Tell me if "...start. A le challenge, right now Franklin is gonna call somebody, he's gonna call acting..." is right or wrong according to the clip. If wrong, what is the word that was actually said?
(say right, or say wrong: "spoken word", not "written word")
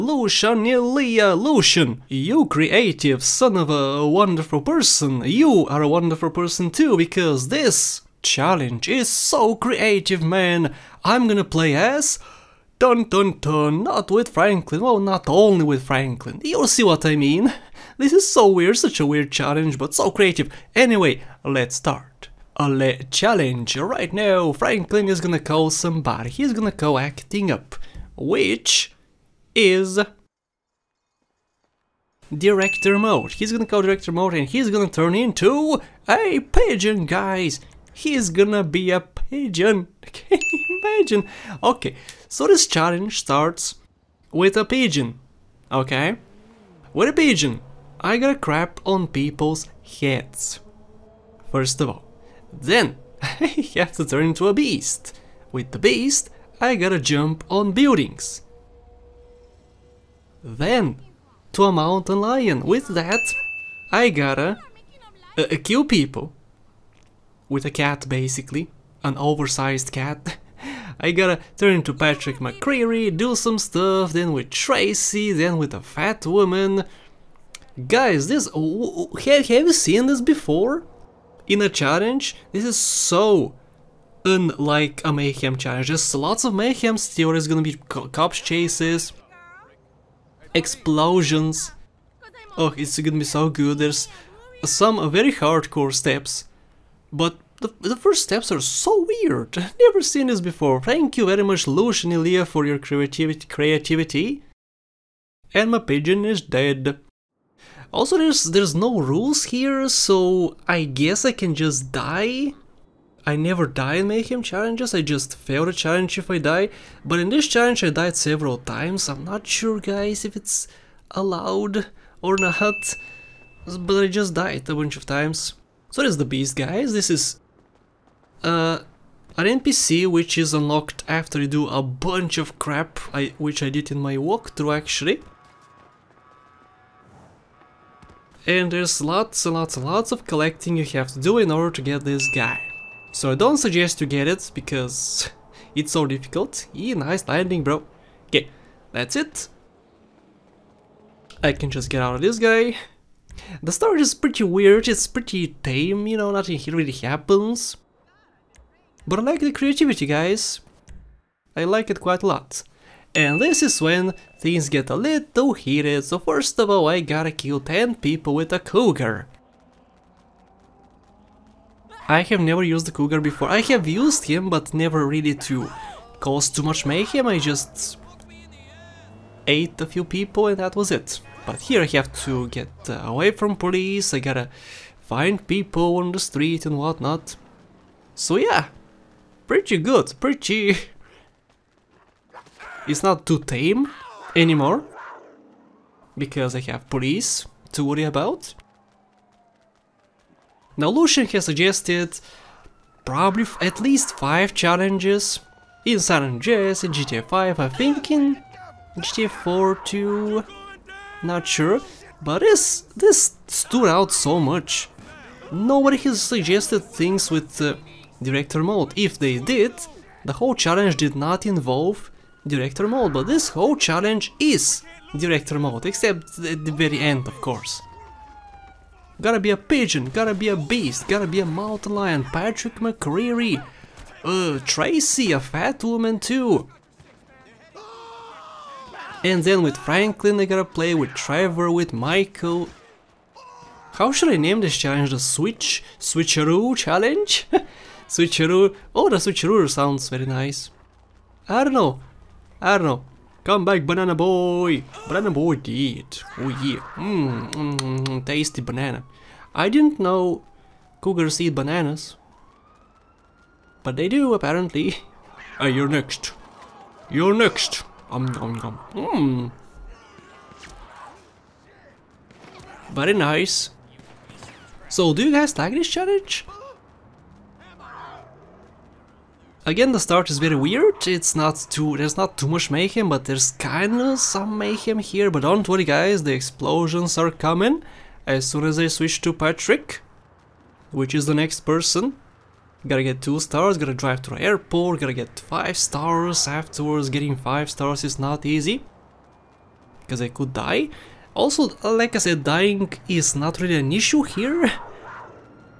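right.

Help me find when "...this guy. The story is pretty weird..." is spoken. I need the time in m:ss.
2:32.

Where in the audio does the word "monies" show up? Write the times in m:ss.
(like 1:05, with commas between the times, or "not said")
not said.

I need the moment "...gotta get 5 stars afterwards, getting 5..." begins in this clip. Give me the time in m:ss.
4:54.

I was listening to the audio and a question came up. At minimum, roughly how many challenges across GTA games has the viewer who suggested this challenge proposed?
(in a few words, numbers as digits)
5.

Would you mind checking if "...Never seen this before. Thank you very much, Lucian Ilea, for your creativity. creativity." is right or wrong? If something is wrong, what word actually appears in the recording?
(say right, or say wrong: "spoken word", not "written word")
right.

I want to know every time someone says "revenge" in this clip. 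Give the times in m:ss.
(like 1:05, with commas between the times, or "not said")
not said.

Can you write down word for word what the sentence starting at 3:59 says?
And then with Franklin I gotta play, with Trevor, with Michael.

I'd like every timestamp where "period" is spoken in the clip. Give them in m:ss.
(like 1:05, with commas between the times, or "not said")
not said.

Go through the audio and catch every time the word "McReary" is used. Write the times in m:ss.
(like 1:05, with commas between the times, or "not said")
1:12, 3:52.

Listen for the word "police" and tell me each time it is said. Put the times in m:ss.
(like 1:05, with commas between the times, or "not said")
3:03, 3:16.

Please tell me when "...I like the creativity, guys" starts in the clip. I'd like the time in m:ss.
2:39.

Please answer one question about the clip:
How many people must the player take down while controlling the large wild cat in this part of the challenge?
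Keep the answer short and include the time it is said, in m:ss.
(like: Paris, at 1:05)
10, at 2:47.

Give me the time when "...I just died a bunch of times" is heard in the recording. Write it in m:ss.
2:04.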